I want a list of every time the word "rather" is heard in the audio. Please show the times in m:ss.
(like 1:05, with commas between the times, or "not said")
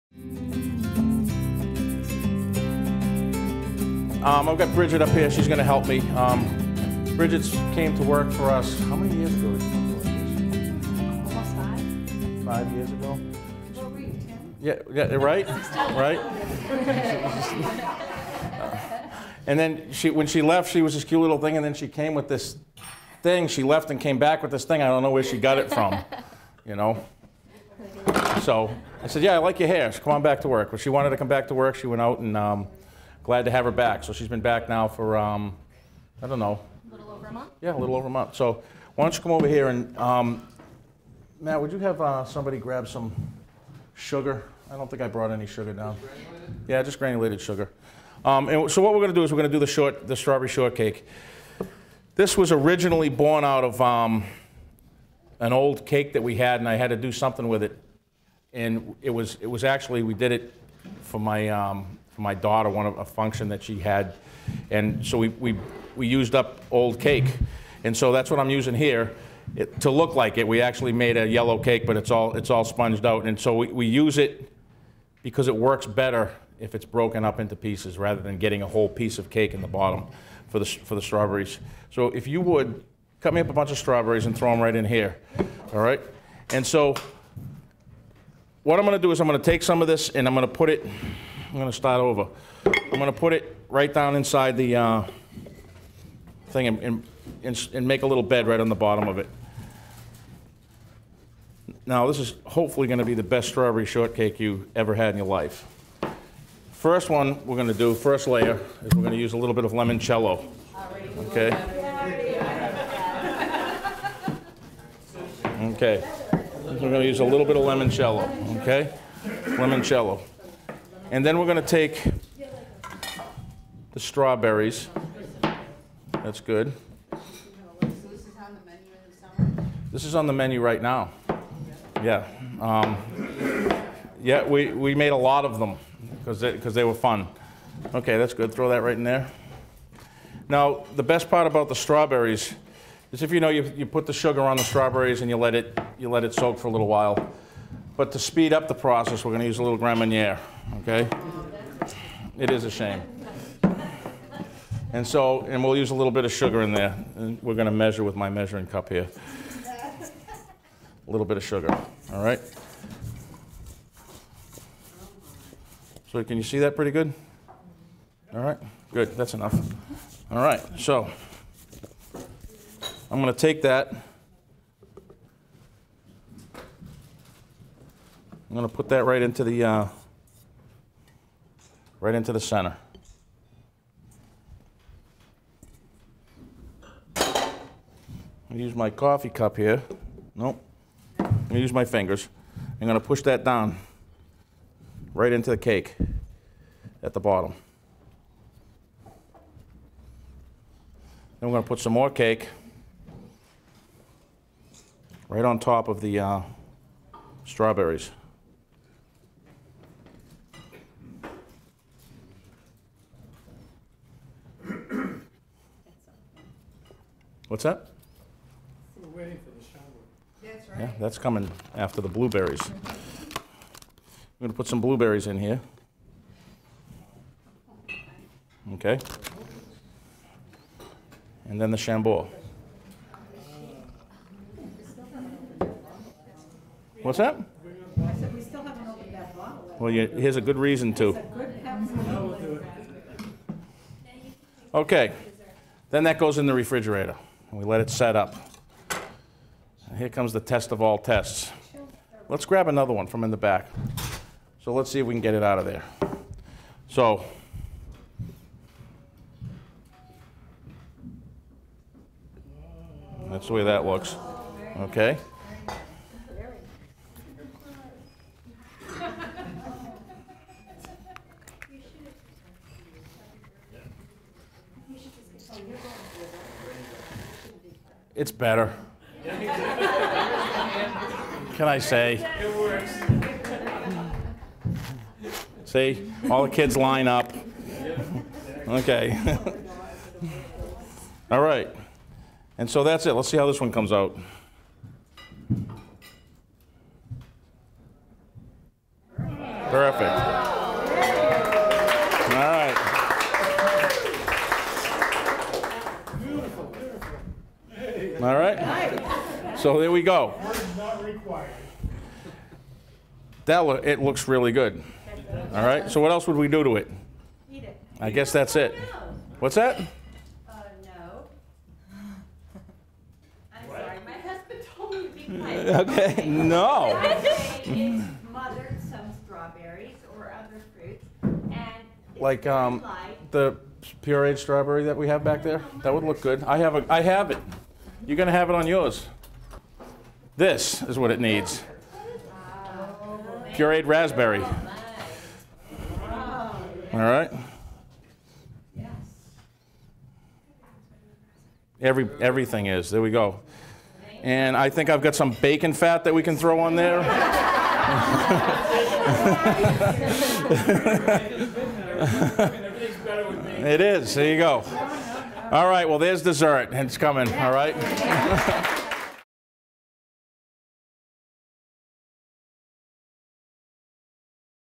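1:17.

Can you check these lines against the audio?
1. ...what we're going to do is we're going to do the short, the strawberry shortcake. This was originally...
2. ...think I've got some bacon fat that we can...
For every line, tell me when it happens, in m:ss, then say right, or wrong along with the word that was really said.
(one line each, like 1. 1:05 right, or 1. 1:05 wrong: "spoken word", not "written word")
1. 0:48 right
2. 5:54 right.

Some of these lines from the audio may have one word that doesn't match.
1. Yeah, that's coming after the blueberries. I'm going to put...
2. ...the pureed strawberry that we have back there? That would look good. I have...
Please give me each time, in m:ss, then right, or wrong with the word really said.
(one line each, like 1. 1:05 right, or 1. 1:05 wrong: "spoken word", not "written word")
1. 3:40 right
2. 5:33 right.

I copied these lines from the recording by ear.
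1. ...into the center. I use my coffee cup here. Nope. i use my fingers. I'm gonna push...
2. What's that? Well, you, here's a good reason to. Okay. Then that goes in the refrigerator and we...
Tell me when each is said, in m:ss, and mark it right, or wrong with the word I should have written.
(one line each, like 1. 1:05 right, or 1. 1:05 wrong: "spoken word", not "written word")
1. 3:02 right
2. 3:57 right.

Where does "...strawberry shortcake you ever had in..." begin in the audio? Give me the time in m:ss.
1:43.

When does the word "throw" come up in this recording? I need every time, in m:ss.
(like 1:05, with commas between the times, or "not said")
1:24, 2:18, 5:56.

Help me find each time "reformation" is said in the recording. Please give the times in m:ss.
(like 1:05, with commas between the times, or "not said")
not said.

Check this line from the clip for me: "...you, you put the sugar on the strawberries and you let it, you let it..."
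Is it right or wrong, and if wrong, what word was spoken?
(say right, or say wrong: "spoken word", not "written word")
right.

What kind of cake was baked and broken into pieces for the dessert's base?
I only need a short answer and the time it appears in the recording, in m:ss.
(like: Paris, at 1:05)
Yellow cake, at 1:11.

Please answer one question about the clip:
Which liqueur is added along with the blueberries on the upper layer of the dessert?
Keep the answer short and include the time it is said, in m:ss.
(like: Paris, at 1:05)
Chambord, at 3:51.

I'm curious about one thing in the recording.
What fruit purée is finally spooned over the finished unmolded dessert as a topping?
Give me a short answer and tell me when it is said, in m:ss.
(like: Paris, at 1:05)
Pureed raspberry, at 5:43.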